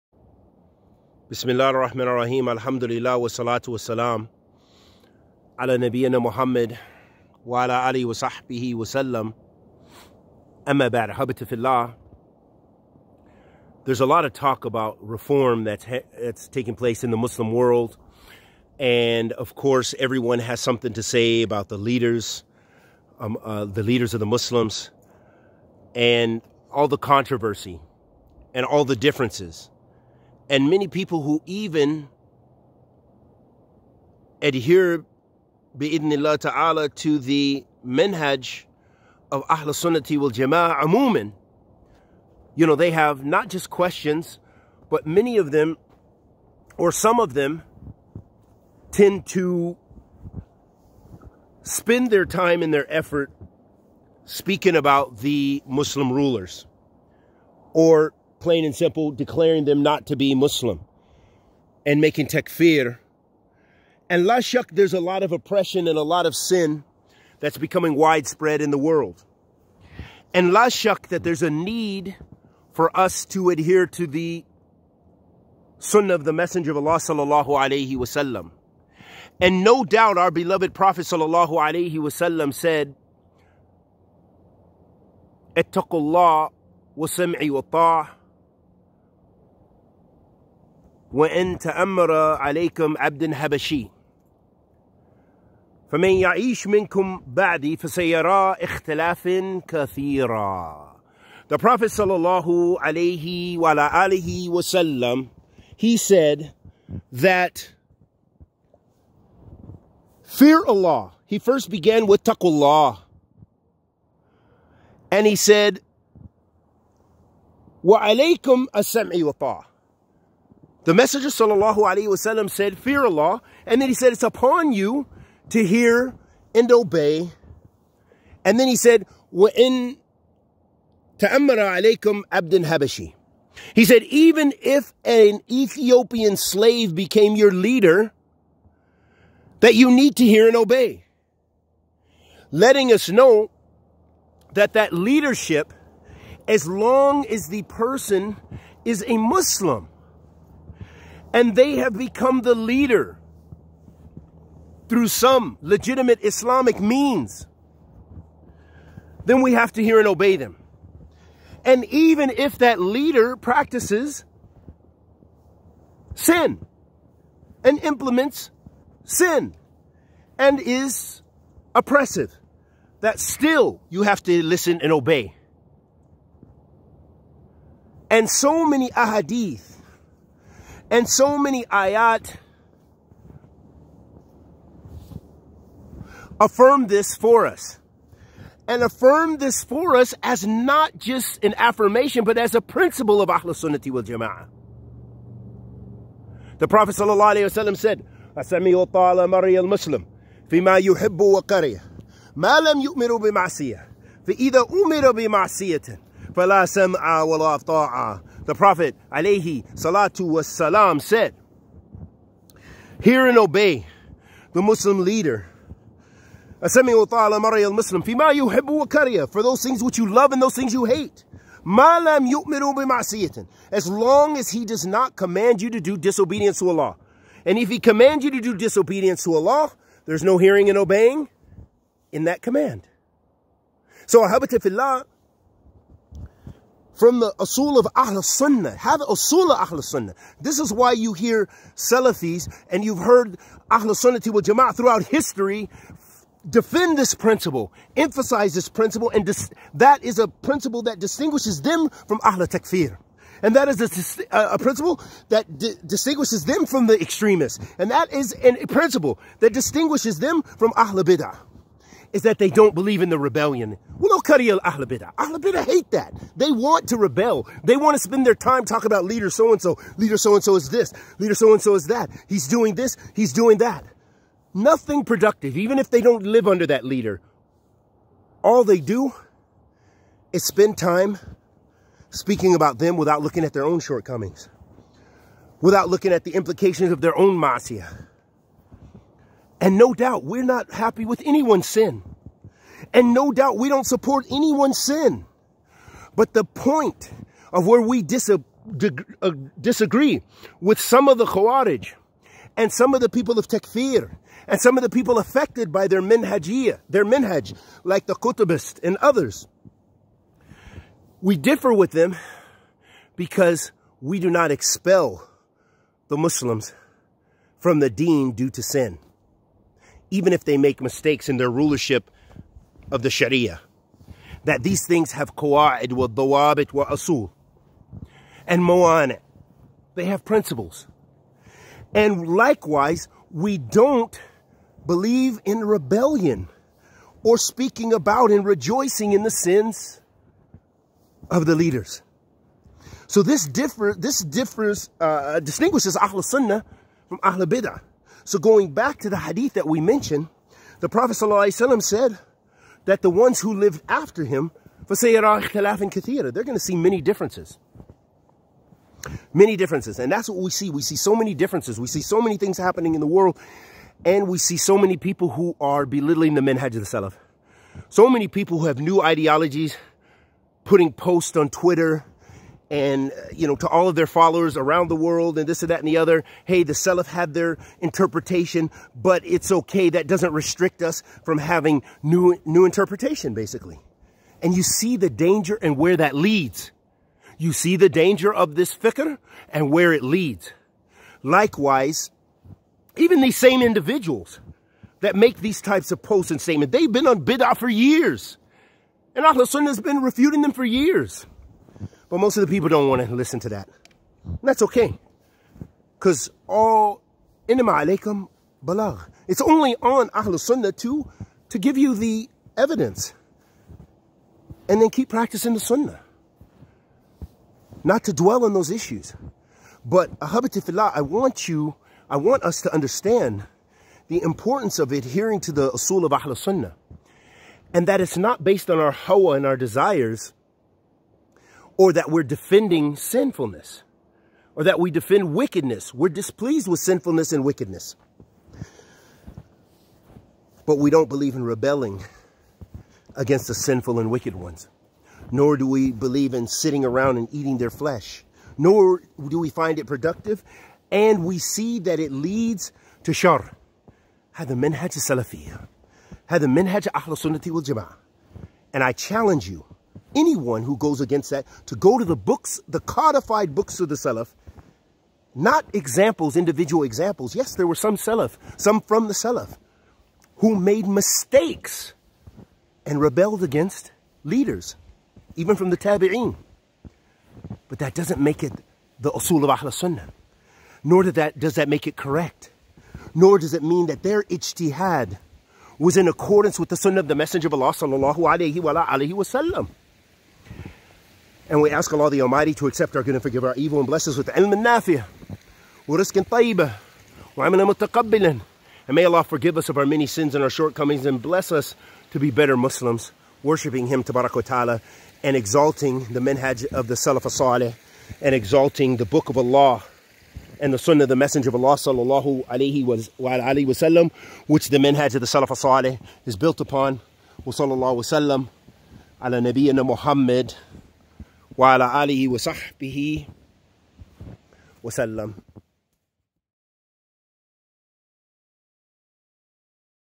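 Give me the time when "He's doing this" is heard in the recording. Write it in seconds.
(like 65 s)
272 s.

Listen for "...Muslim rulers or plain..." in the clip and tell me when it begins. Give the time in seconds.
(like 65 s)
55 s.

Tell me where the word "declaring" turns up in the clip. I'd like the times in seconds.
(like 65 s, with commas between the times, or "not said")
59 s.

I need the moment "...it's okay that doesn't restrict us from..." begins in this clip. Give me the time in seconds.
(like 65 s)
379 s.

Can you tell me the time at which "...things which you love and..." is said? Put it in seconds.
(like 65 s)
219 s.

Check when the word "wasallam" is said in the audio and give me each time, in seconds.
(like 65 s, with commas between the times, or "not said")
77 s, 81 s, 122 s, 517 s.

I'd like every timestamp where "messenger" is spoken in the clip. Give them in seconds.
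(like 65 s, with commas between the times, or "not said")
76 s, 120 s, 487 s, 511 s.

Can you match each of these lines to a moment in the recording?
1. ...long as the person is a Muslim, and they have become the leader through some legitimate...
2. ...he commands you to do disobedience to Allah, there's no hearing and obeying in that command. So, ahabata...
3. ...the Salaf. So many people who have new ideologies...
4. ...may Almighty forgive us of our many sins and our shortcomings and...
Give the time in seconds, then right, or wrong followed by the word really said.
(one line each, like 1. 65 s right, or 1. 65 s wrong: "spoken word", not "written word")
1. 146 s right
2. 227 s right
3. 366 s right
4. 498 s wrong: "Allah", not "Almighty".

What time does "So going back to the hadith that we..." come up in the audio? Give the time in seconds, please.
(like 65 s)
348 s.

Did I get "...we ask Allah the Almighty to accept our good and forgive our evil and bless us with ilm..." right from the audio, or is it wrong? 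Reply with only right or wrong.
right.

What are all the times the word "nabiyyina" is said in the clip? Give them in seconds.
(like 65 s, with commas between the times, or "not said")
5 s, 519 s.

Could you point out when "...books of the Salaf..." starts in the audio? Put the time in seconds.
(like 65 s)
463 s.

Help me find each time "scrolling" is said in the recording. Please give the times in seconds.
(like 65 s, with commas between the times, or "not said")
not said.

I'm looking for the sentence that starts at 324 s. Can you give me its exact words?
That these things have qawa'id wa dawabit wa asul and mo'ane.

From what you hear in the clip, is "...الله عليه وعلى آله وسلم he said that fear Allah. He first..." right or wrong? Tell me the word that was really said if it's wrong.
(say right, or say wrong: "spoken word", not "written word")
right.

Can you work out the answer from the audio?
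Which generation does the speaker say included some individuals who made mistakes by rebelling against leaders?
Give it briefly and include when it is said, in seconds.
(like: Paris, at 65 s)
Tabi'een, at 475 s.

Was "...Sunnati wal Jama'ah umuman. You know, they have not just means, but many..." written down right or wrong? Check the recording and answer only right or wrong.
wrong.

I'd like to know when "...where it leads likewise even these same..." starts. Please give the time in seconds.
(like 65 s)
389 s.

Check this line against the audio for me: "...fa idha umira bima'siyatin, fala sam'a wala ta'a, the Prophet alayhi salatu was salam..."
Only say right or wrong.
right.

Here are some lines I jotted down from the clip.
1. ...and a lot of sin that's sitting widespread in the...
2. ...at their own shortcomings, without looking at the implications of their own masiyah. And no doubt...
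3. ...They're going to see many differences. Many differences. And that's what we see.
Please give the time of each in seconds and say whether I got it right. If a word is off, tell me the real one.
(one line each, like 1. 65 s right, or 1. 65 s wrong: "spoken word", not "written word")
1. 65 s wrong: "becoming", not "sitting"
2. 283 s right
3. 356 s right.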